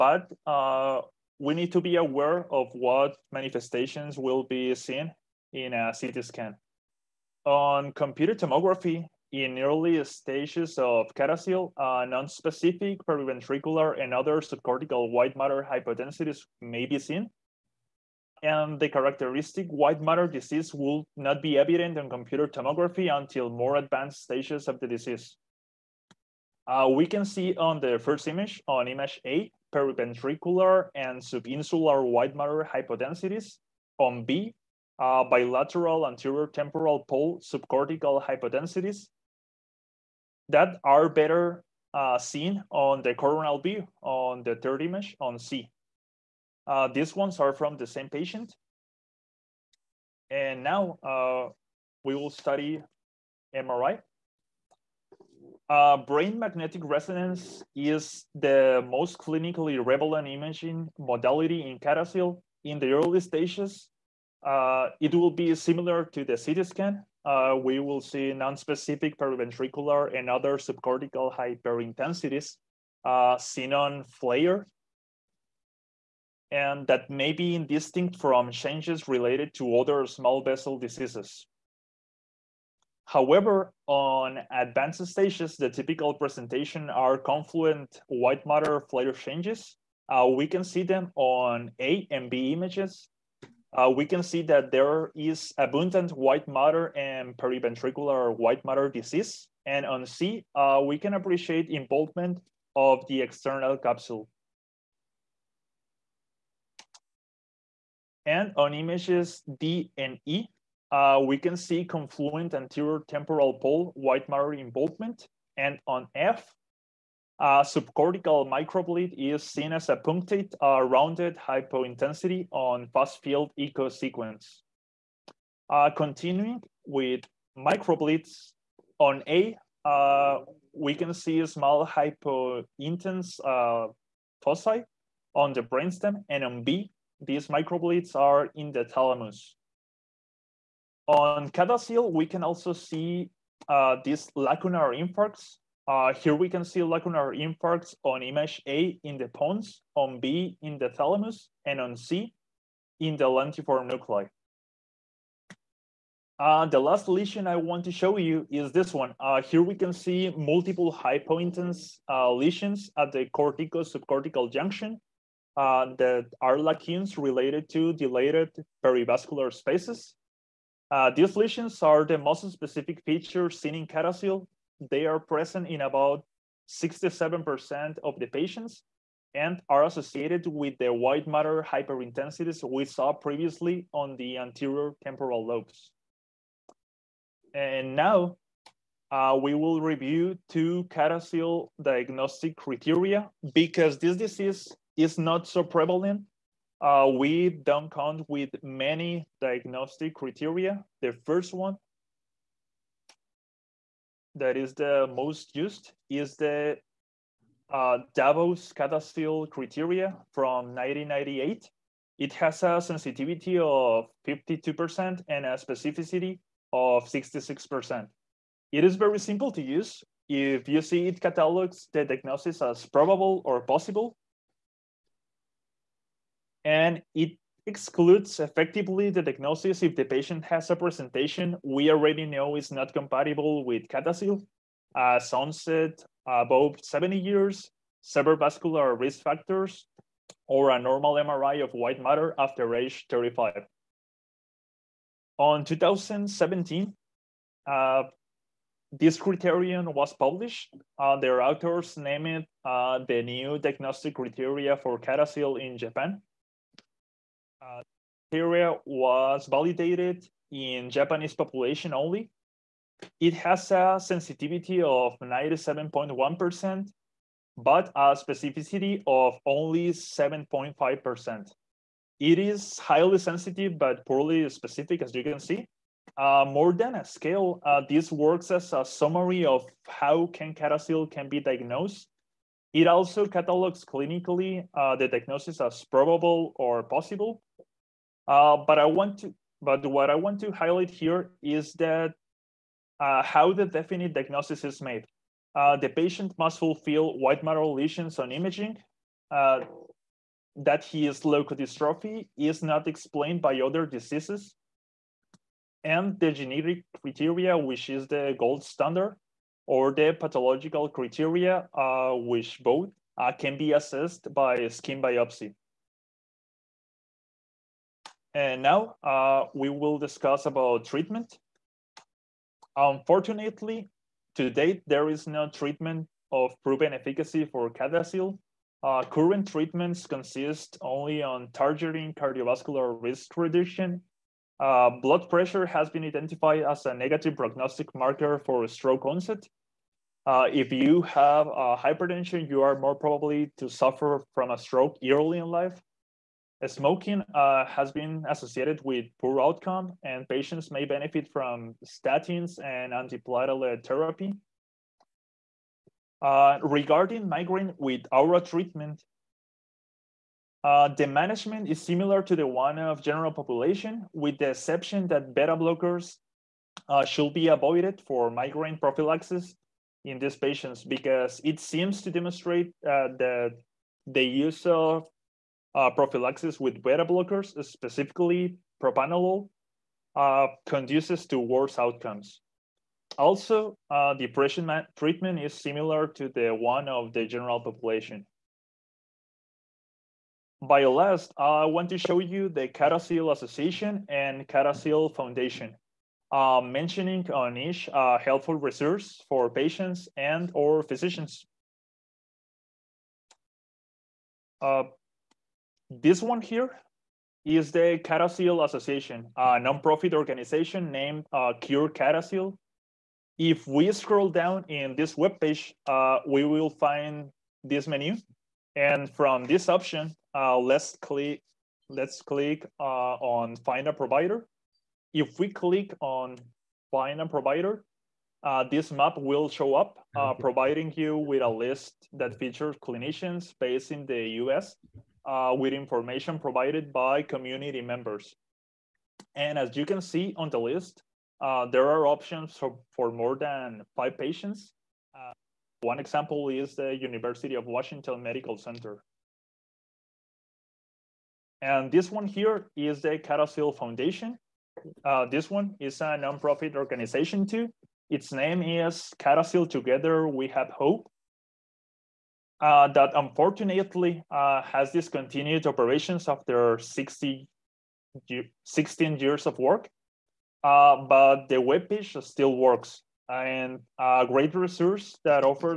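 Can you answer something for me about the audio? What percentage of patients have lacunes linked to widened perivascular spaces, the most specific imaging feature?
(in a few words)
67%.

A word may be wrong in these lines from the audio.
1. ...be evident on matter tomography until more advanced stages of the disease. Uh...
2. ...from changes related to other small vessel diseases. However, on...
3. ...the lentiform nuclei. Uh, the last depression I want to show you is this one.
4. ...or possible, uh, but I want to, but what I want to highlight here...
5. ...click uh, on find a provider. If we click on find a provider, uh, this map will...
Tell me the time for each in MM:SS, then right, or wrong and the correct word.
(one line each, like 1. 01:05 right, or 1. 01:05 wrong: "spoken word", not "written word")
1. 00:21 wrong: "computer", not "matter"
2. 01:18 right
3. 02:33 wrong: "lesion", not "depression"
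4. 04:46 right
5. 07:02 right.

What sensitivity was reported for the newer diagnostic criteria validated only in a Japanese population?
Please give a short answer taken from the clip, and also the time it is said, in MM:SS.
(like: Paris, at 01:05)
97.1%, at 04:25.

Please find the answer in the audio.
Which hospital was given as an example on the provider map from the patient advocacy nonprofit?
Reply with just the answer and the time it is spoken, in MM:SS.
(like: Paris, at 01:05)
University of Washington Medical Center, at 07:26.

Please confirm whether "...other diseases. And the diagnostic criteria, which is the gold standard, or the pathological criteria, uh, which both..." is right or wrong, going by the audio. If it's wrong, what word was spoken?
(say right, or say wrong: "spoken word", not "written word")
wrong: "genetic", not "diagnostic".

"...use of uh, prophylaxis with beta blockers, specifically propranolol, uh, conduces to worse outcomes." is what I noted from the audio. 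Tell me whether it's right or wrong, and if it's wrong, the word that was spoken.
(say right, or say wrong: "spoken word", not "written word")
right.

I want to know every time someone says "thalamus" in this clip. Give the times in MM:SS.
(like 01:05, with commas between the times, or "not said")
02:18, 02:30.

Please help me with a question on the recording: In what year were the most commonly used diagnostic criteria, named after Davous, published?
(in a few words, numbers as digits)
1998.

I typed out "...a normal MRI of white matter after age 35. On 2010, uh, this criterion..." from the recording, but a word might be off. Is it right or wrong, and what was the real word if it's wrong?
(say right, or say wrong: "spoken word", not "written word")
wrong: "2017", not "2010".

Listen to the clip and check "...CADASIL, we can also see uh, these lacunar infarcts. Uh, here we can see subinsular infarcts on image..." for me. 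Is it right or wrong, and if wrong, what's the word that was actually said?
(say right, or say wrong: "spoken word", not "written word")
wrong: "lacunar", not "subinsular".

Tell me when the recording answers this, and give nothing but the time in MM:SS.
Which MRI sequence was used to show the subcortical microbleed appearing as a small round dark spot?
02:02.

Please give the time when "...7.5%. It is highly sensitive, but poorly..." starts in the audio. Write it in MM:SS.
04:29.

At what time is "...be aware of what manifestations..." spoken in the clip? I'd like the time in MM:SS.
00:01.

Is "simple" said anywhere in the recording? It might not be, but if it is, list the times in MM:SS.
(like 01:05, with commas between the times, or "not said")
03:39.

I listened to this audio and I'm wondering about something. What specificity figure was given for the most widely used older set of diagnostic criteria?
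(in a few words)
66%.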